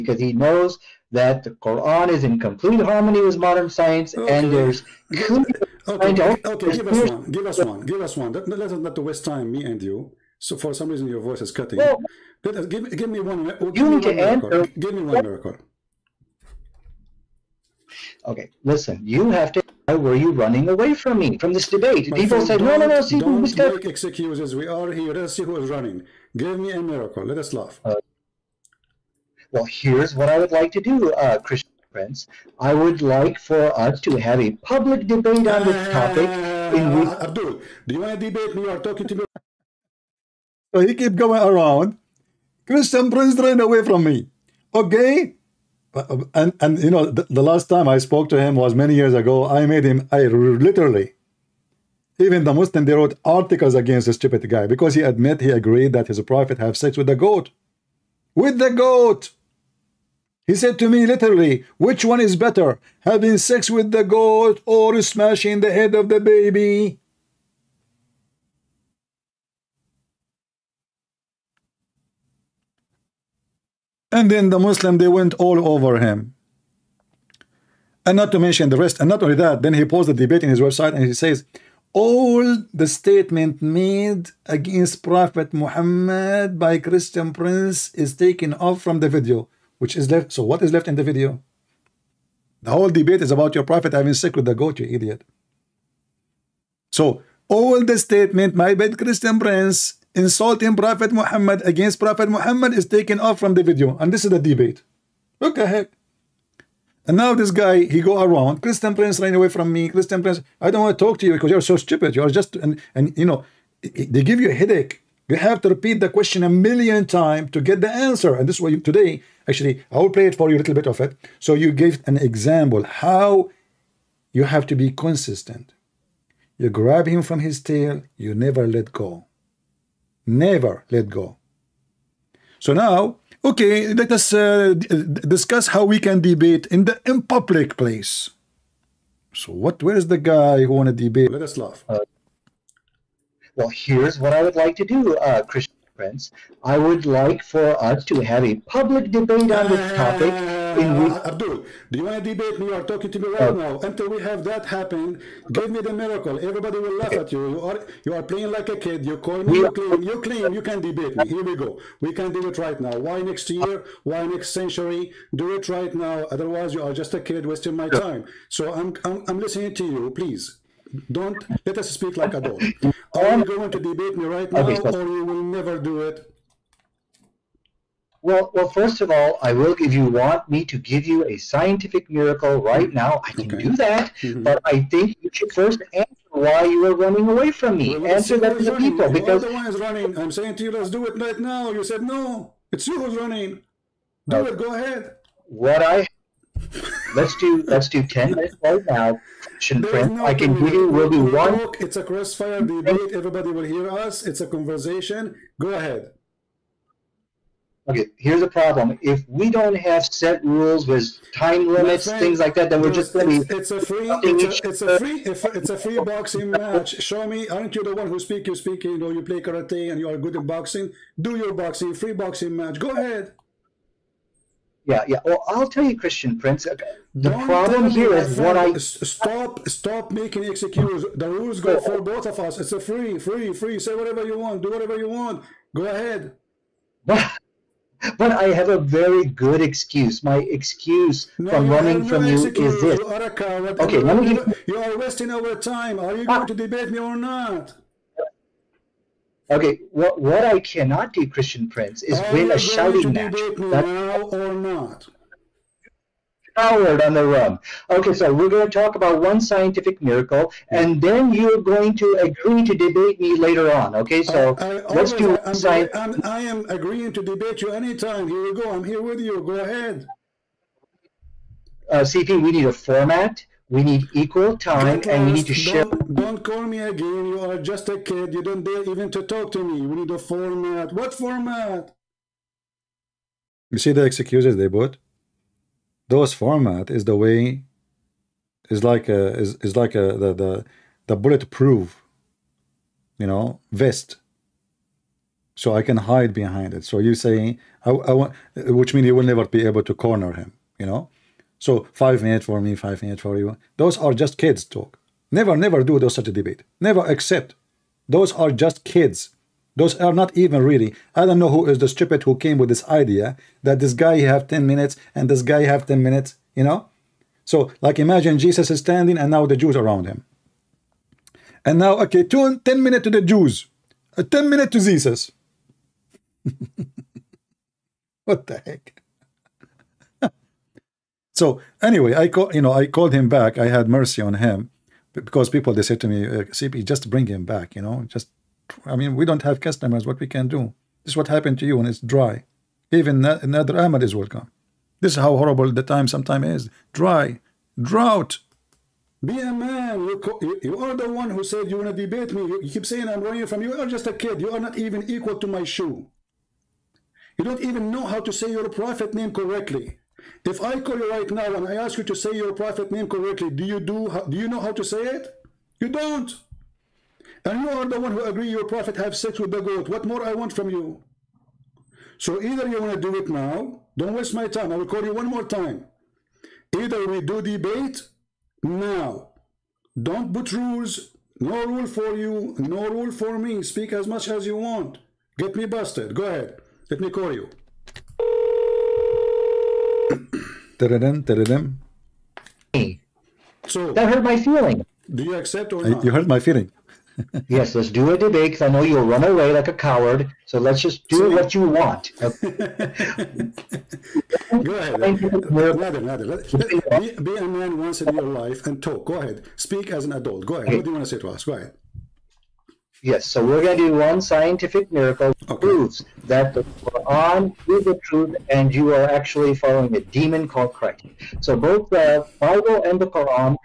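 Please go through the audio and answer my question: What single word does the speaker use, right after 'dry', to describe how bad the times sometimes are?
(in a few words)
Drought.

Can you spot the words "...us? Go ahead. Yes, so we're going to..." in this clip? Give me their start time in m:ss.
6:51.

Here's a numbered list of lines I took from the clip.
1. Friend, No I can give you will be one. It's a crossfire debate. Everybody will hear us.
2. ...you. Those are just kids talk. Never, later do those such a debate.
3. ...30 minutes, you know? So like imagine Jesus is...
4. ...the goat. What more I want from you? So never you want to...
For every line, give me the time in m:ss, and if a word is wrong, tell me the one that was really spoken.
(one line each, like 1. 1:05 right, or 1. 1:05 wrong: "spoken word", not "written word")
1. 3:19 right
2. 5:03 wrong: "never", not "later"
3. 5:15 wrong: "10", not "30"
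4. 6:09 wrong: "either", not "never".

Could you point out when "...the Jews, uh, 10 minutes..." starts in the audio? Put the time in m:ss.
5:23.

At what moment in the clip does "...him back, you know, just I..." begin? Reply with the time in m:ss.
5:37.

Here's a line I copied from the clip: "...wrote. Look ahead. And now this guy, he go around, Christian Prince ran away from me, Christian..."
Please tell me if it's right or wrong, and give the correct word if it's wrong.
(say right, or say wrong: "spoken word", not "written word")
wrong: "debate", not "wrote".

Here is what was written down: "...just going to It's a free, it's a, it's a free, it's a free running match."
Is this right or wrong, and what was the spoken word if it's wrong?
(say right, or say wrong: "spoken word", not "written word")
wrong: "boxing", not "running".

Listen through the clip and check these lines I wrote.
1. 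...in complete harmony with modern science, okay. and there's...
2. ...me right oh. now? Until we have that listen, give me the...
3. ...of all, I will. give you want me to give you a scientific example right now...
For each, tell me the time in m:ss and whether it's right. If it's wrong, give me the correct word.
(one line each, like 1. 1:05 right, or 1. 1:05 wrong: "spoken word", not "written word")
1. 0:02 right
2. 2:33 wrong: "happen", not "listen"
3. 2:59 wrong: "miracle", not "example".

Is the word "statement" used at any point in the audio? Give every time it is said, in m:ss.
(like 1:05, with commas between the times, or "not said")
1:22, 1:37.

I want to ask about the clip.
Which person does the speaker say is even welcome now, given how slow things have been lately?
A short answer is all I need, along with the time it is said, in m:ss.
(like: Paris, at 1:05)
Nader Ahmad, at 5:43.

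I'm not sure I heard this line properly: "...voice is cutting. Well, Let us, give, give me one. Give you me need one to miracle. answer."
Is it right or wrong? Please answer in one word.
right.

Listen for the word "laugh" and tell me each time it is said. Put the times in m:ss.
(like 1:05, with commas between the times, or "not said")
0:27, 2:21, 2:36.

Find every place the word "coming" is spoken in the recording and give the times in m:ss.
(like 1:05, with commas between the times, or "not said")
not said.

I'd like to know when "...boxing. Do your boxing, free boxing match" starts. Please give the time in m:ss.
3:40.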